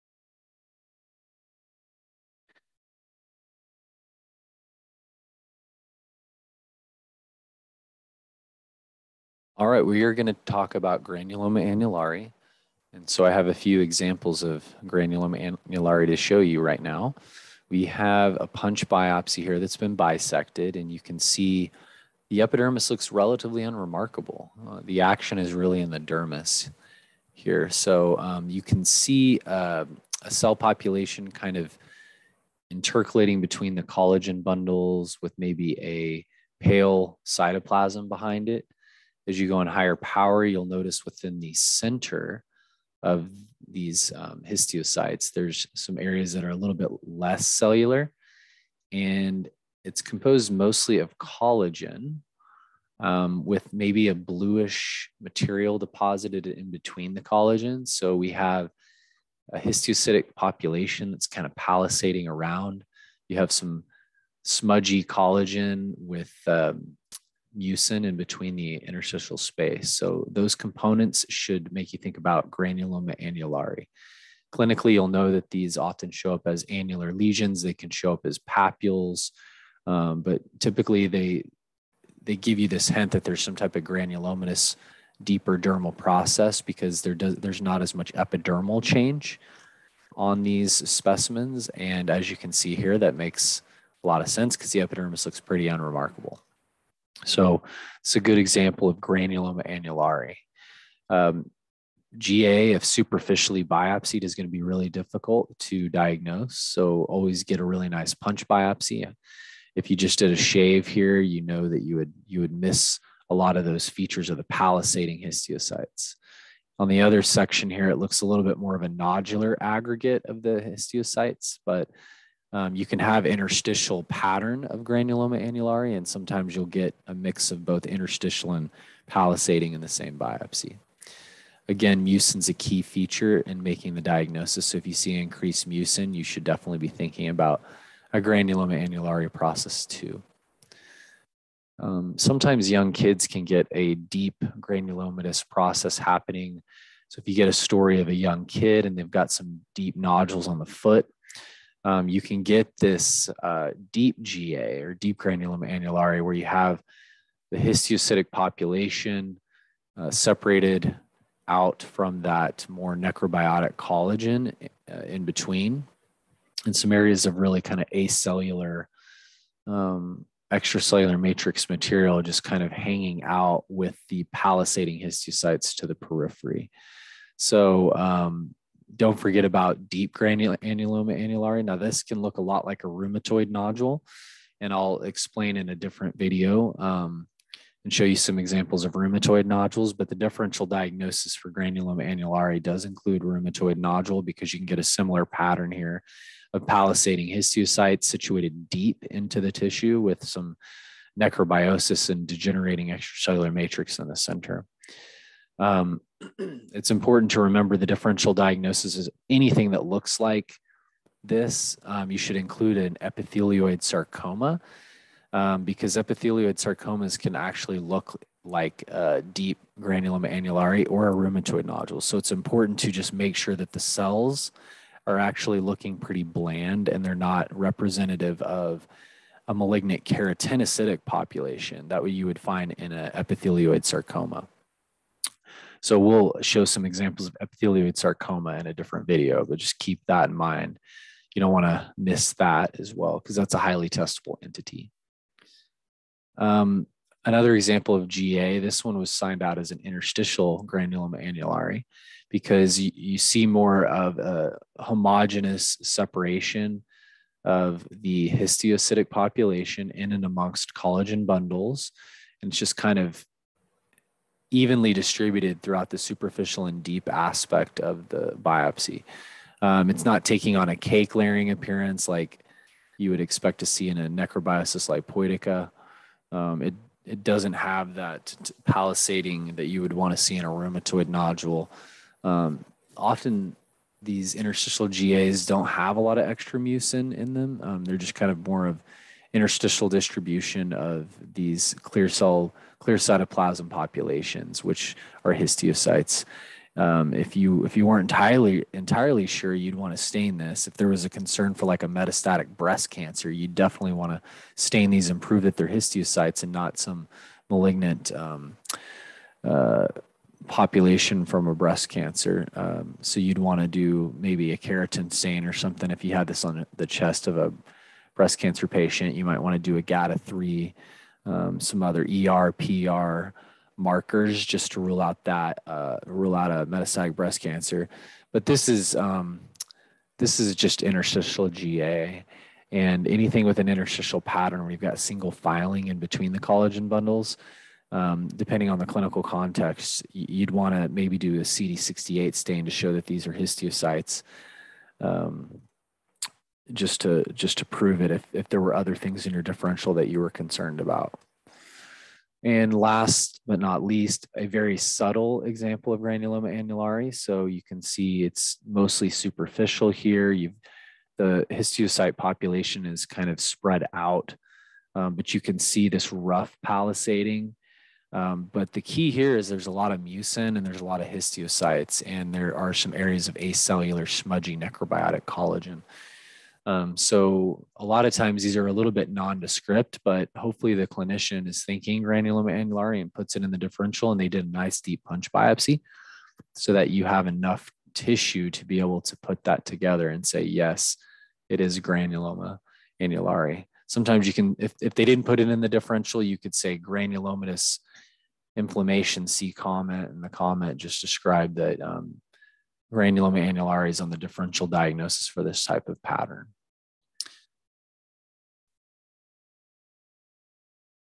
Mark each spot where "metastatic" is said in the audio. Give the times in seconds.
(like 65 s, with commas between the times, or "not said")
301 s, 326 s.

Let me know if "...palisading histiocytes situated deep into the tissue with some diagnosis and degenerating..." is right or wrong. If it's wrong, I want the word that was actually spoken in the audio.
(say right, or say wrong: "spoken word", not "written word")
wrong: "necrobiosis", not "diagnosis".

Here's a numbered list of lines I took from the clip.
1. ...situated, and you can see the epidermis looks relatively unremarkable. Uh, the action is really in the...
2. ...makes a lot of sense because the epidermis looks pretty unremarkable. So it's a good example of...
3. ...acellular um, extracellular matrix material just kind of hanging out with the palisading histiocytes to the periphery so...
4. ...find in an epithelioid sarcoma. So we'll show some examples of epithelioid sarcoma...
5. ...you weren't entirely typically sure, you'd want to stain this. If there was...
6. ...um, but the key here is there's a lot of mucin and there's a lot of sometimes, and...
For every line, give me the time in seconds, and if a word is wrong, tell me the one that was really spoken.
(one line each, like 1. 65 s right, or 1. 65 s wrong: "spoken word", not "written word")
1. 19 s wrong: "bisected", not "situated"
2. 93 s right
3. 167 s right
4. 232 s right
5. 297 s wrong: "entirely", not "typically"
6. 368 s wrong: "histiocytes", not "sometimes".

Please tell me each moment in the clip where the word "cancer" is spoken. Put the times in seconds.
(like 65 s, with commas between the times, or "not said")
302 s, 311 s, 318 s, 327 s.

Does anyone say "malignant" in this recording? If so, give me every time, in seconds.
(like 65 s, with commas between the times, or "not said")
229 s, 307 s.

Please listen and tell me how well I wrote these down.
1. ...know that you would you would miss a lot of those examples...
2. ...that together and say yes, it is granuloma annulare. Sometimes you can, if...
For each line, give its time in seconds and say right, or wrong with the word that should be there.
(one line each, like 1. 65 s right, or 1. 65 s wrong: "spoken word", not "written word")
1. 111 s wrong: "features", not "examples"
2. 389 s right.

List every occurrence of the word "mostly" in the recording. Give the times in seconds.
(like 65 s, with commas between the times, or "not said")
50 s, 358 s.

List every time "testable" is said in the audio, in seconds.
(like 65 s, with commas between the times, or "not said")
243 s.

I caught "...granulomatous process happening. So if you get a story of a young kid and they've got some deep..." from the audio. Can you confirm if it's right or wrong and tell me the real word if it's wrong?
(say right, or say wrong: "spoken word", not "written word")
right.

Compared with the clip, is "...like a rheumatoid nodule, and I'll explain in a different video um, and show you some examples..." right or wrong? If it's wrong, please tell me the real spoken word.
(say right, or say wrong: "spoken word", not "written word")
right.